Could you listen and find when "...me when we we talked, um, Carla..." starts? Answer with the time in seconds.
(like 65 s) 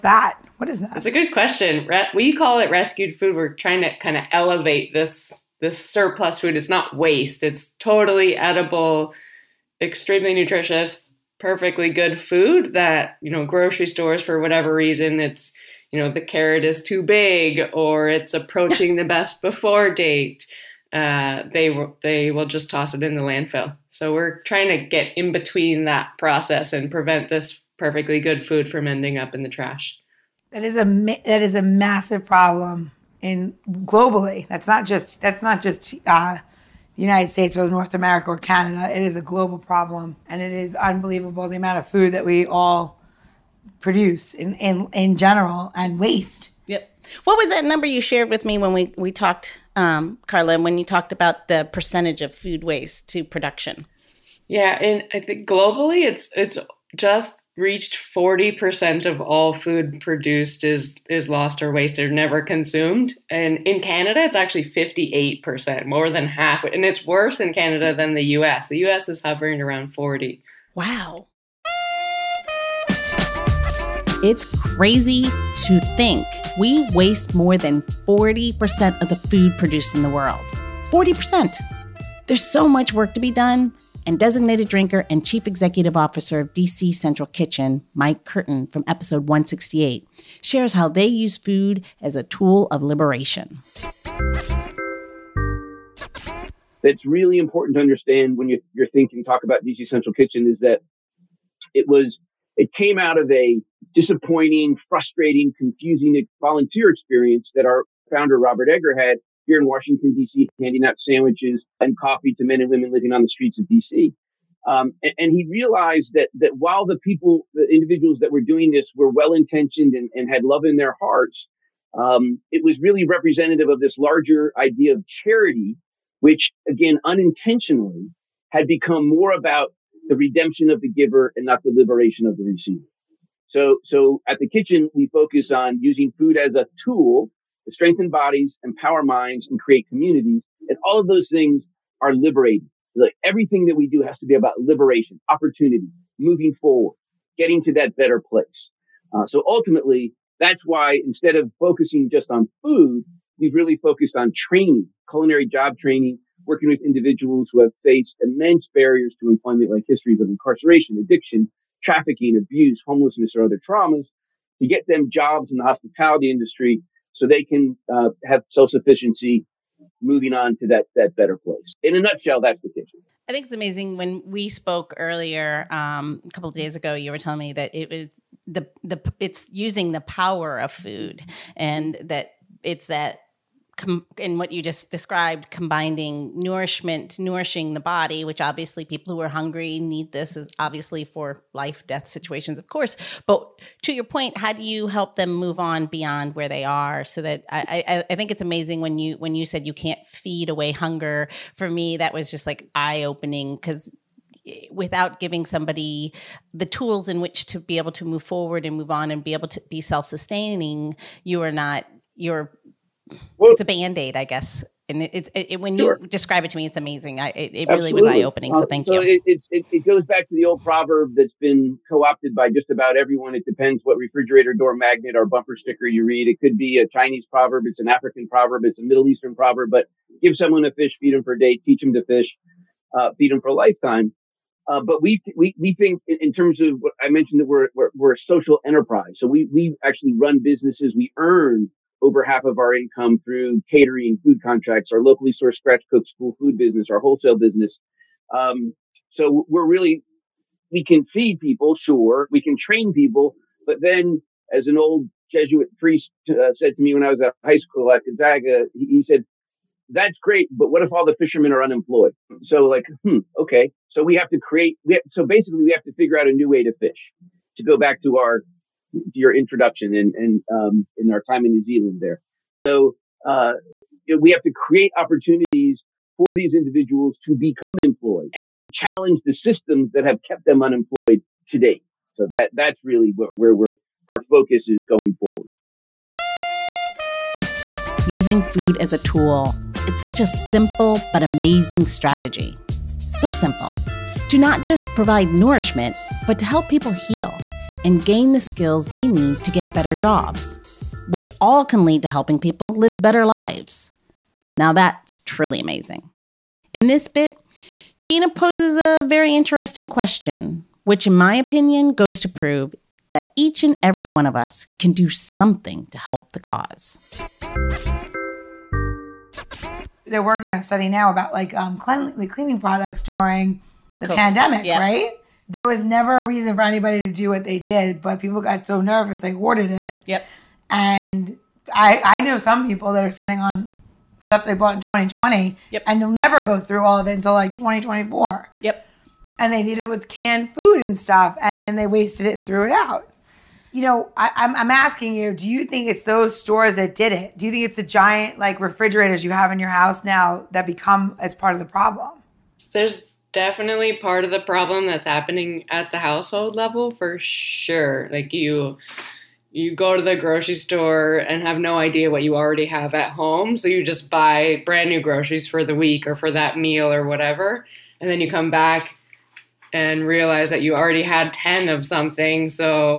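48 s.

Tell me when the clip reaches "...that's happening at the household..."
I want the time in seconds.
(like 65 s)
354 s.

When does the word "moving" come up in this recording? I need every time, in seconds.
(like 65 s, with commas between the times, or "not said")
146 s, 170 s.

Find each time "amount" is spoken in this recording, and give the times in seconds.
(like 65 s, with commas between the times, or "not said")
41 s.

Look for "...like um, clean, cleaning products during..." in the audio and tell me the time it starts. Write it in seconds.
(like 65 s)
321 s.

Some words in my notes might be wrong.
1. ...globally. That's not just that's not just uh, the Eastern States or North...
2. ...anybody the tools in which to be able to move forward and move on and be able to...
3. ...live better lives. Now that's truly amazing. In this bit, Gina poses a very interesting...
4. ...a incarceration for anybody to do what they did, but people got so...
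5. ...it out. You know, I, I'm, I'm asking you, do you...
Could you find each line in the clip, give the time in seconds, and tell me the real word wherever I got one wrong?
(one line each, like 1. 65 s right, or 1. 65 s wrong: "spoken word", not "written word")
1. 33 s wrong: "United", not "Eastern"
2. 205 s wrong: "somebody", not "anybody"
3. 302 s right
4. 326 s wrong: "reason", not "incarceration"
5. 342 s right.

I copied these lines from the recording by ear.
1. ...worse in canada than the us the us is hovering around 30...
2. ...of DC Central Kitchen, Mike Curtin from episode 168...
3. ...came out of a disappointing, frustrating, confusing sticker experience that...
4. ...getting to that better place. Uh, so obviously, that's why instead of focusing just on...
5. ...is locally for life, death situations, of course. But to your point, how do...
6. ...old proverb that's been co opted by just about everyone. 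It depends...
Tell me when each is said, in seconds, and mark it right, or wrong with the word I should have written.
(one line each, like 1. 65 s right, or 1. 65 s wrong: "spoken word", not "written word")
1. 67 s wrong: "40", not "30"
2. 86 s right
3. 102 s wrong: "volunteer", not "sticker"
4. 147 s wrong: "ultimately", not "obviously"
5. 190 s wrong: "obviously", not "locally"
6. 220 s right.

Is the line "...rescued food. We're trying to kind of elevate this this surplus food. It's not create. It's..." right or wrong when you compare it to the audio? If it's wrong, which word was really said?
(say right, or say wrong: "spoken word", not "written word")
wrong: "waste", not "create".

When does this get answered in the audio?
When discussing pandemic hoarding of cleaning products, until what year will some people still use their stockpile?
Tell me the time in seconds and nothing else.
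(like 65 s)
337 s.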